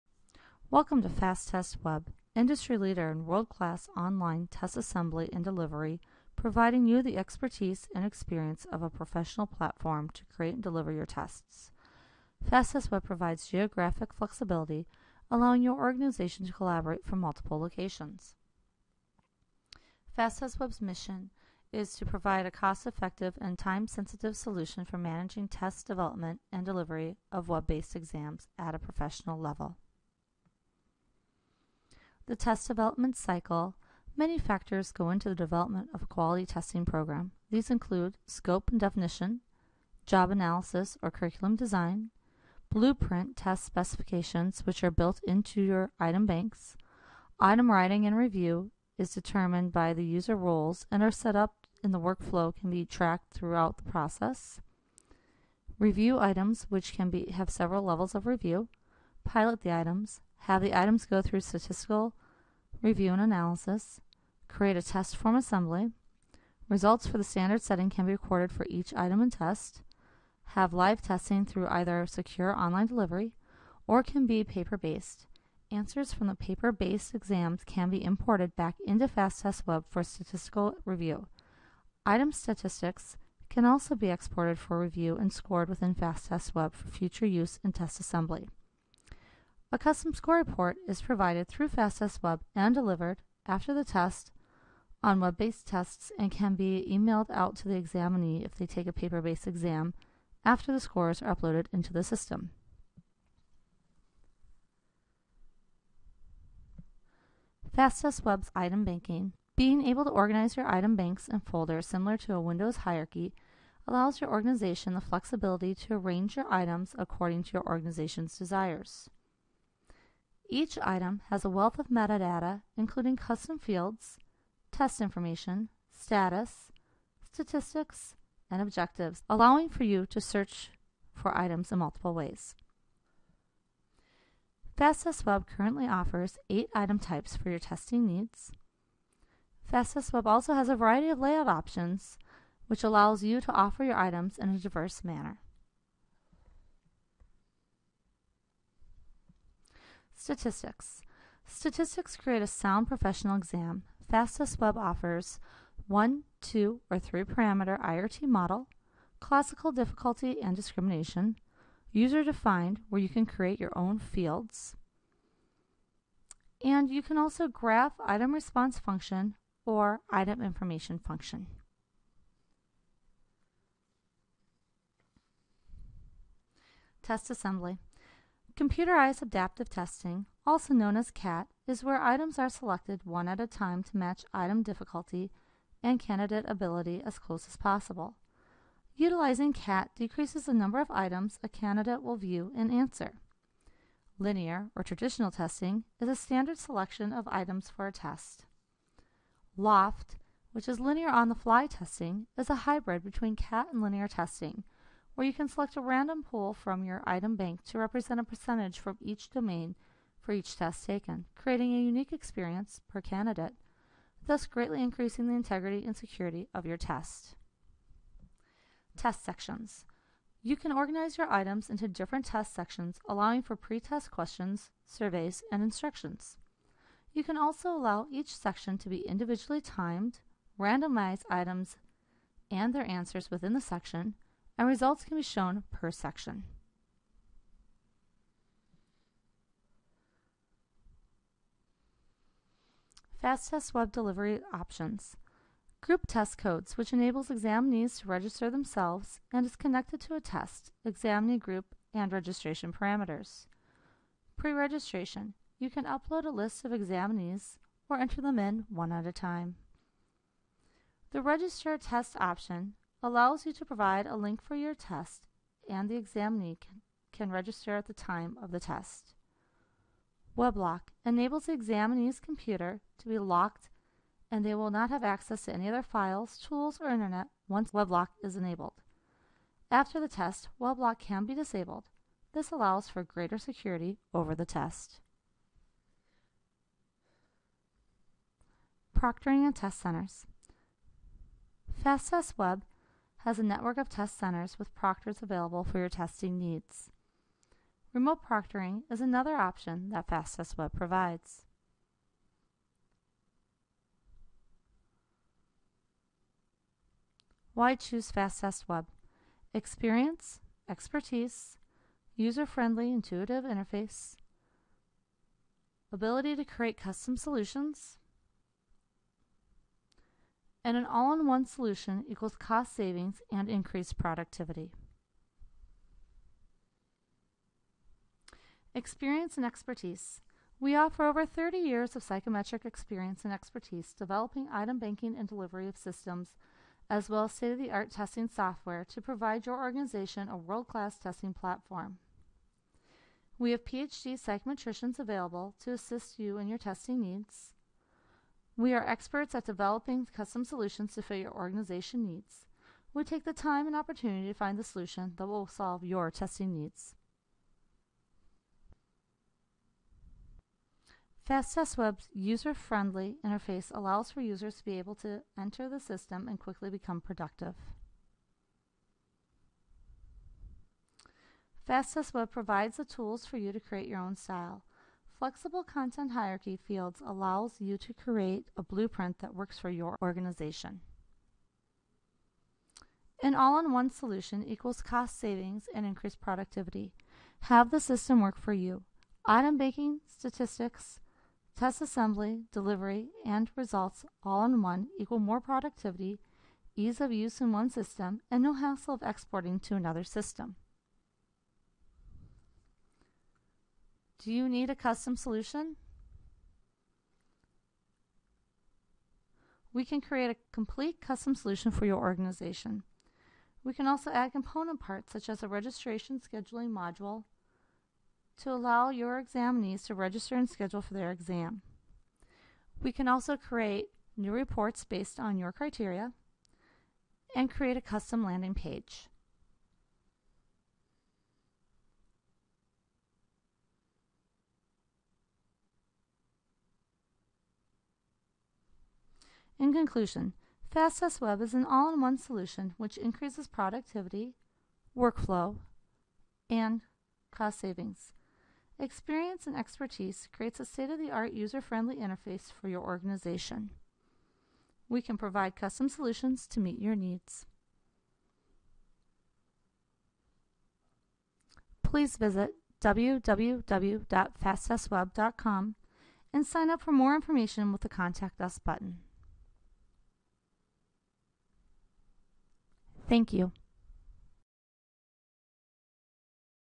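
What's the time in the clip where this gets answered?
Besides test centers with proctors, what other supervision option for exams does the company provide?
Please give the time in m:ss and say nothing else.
4:57.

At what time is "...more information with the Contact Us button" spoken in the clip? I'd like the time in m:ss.
7:46.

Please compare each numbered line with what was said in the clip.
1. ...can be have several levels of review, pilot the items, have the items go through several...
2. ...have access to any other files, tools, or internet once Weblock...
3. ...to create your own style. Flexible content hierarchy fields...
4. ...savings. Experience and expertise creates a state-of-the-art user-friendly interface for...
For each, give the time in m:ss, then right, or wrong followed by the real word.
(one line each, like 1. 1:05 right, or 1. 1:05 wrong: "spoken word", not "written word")
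1. 0:56 wrong: "statistical", not "several"
2. 4:34 right
3. 6:13 right
4. 7:27 right.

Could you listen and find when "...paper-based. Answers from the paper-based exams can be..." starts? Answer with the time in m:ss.
1:14.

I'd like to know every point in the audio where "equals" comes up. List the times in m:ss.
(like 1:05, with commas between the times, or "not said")
5:22, 6:24, 6:34.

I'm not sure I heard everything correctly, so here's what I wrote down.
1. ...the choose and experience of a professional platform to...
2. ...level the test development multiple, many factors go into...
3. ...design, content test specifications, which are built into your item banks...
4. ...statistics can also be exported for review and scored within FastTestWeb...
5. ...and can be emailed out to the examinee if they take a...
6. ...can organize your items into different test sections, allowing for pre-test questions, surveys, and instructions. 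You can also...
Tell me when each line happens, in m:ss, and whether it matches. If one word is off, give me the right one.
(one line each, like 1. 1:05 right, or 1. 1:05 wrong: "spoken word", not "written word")
1. 0:07 wrong: "expertise", not "choose"
2. 0:29 wrong: "cycle", not "multiple"
3. 0:41 wrong: "blueprint", not "content"
4. 1:22 right
5. 1:36 right
6. 3:40 right.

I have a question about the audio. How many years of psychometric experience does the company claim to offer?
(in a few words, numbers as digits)
30.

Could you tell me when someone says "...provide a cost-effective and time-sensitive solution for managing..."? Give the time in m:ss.
0:22.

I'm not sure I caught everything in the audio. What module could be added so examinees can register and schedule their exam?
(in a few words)
registration scheduling module.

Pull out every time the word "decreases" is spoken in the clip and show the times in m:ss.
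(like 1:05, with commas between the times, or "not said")
3:09.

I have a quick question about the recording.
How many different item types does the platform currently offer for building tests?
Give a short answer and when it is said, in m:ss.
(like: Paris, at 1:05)
8, at 2:16.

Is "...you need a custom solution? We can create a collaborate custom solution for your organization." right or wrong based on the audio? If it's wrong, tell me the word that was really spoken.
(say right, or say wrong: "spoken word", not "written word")
wrong: "complete", not "collaborate".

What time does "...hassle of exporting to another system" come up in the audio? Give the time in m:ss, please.
6:38.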